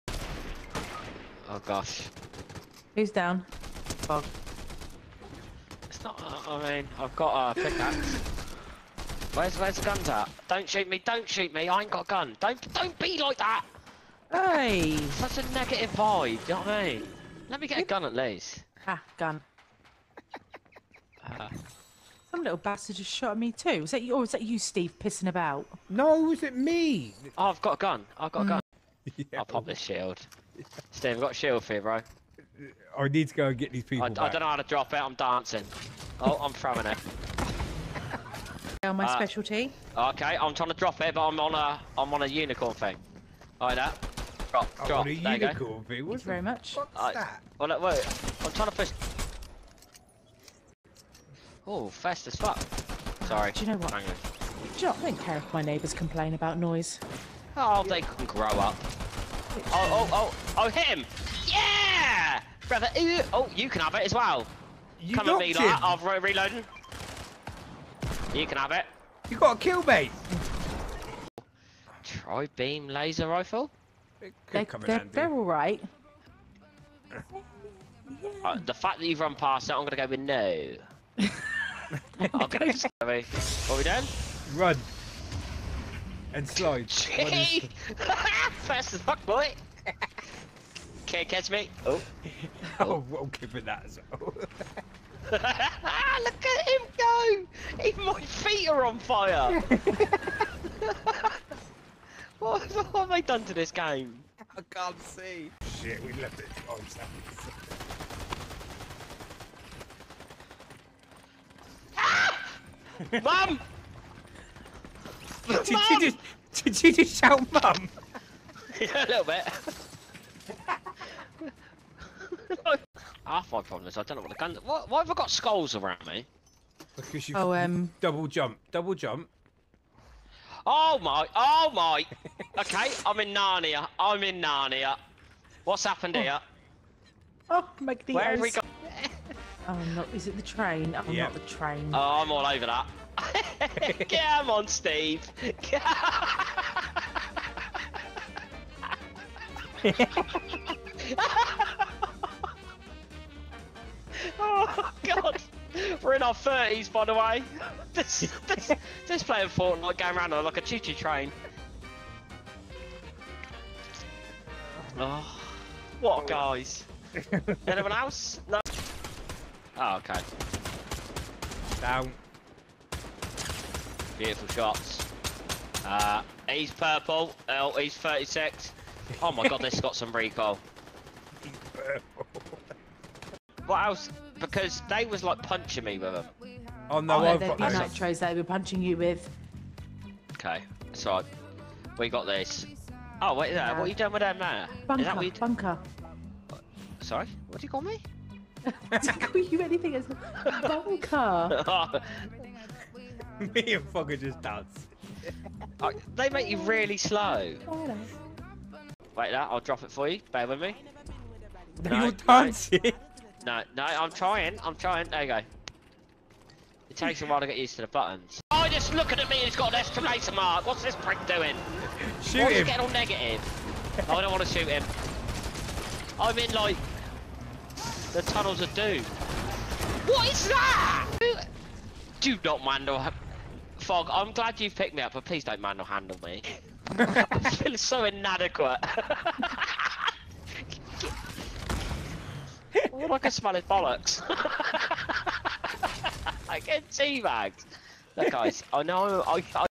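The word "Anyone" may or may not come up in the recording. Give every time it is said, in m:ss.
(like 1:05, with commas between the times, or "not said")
2:47.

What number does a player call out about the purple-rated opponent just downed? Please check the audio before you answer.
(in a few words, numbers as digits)
36.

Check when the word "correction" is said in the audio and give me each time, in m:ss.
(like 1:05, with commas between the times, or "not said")
not said.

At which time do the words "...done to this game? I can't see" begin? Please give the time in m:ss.
1:43.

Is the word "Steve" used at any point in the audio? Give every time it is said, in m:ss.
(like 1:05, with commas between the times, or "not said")
0:24, 0:30, 2:24.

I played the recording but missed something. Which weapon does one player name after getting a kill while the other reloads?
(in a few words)
Tri beam laser rifle.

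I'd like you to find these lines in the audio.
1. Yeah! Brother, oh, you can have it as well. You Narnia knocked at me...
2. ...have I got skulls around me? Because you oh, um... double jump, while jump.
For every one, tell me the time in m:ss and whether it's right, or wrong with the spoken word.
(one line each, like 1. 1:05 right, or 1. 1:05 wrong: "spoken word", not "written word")
1. 1:01 wrong: "Come", not "Narnia"
2. 2:04 wrong: "double", not "while".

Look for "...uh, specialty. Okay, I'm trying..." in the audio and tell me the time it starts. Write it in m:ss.
0:39.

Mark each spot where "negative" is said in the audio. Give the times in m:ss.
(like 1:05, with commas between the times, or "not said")
0:15, 3:42.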